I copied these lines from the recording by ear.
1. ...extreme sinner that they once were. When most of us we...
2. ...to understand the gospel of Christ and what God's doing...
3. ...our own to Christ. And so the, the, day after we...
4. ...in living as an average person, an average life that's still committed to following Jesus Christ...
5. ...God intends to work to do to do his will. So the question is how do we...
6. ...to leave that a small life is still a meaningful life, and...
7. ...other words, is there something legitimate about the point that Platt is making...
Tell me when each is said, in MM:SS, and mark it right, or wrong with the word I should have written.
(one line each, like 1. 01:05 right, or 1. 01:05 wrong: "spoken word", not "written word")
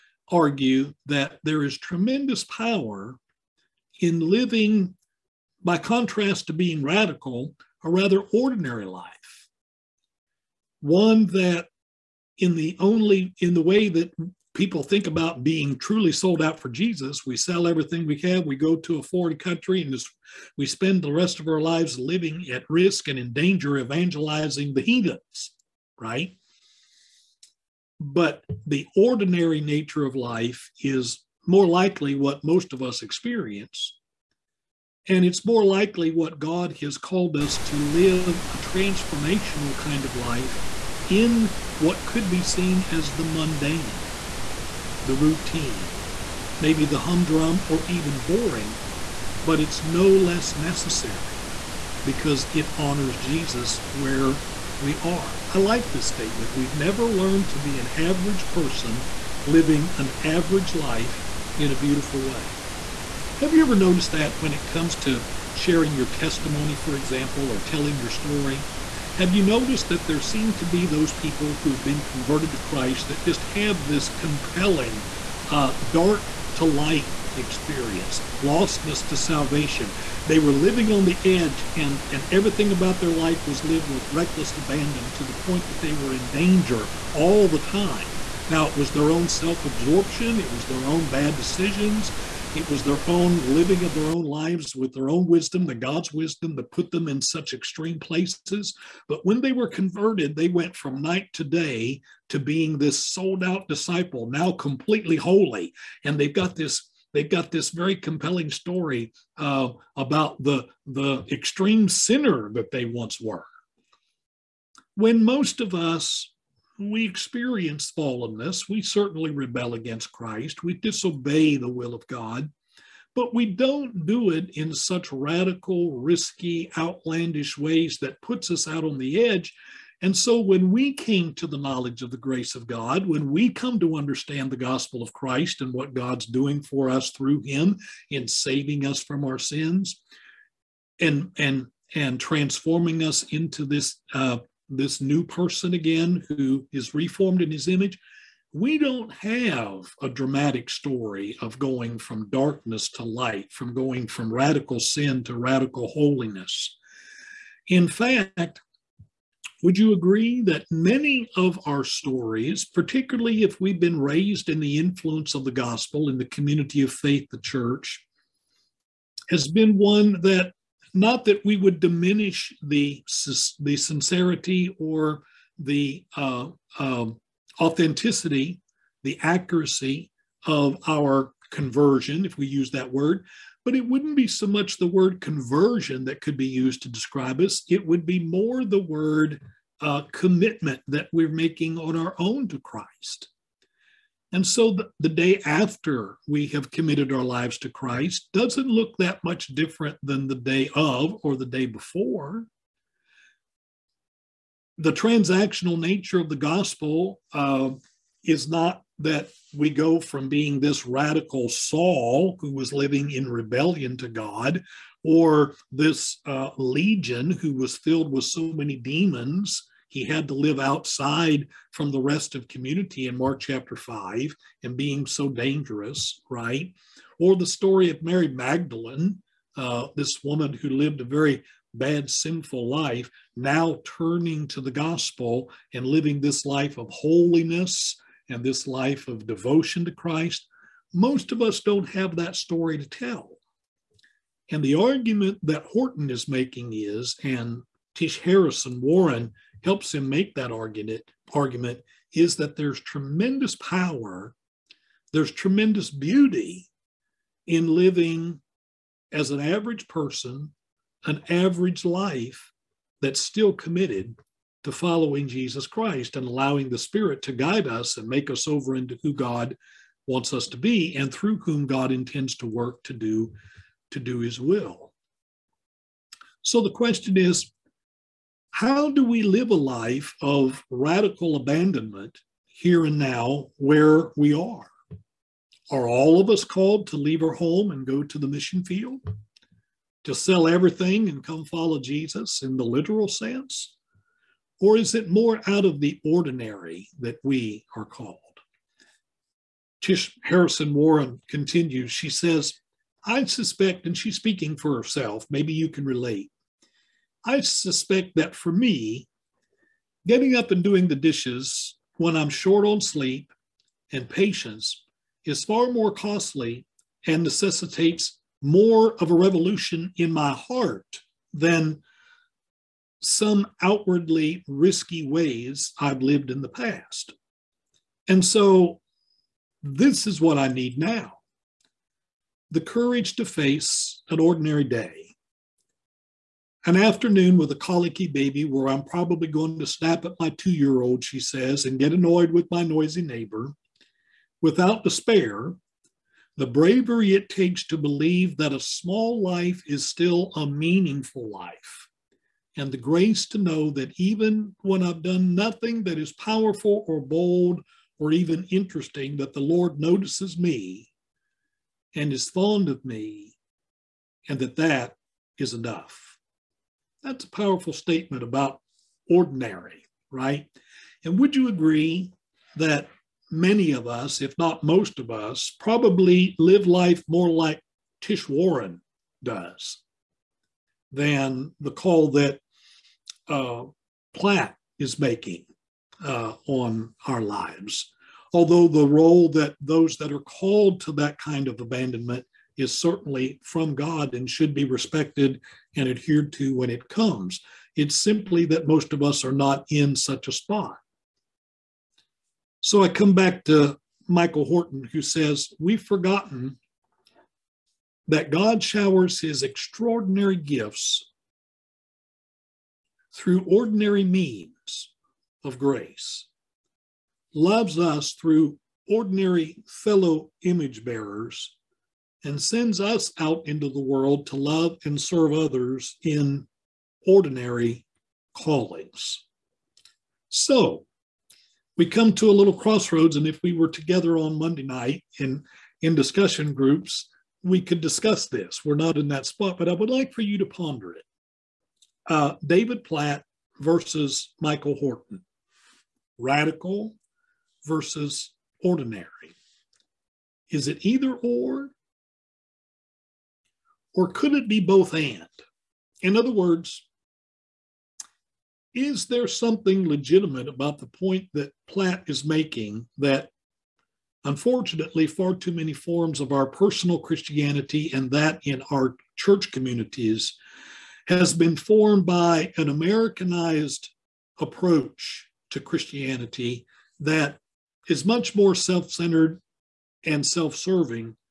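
1. 01:51 right
2. 02:13 right
3. 03:11 right
4. 04:17 right
5. 04:31 right
6. 05:47 wrong: "believe", not "leave"
7. 07:36 right.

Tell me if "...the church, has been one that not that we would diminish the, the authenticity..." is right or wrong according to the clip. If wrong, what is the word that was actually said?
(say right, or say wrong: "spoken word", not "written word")
wrong: "sincerity", not "authenticity".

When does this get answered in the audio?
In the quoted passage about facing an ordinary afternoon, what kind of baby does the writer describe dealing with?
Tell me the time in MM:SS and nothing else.
05:37.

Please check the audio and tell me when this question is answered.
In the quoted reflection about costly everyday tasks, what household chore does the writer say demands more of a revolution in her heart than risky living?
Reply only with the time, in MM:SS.
05:10.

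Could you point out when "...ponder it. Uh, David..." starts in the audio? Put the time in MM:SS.
07:20.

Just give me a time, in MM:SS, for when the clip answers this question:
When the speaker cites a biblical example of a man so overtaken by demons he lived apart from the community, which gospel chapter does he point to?
03:43.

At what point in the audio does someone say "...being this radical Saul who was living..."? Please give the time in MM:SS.
03:30.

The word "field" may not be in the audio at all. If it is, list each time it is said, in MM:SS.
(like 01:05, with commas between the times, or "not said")
04:48.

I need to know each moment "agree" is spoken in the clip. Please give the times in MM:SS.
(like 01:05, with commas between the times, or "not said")
02:39, 06:11.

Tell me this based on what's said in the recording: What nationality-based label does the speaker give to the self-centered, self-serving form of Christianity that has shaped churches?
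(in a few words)
Americanized.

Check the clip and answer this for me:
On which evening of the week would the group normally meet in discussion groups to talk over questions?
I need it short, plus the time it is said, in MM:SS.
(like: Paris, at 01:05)
Monday night, at 07:14.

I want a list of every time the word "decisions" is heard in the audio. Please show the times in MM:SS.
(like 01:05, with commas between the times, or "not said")
01:31.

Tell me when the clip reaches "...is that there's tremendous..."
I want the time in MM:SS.
04:12.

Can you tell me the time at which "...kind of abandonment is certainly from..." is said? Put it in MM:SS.
06:31.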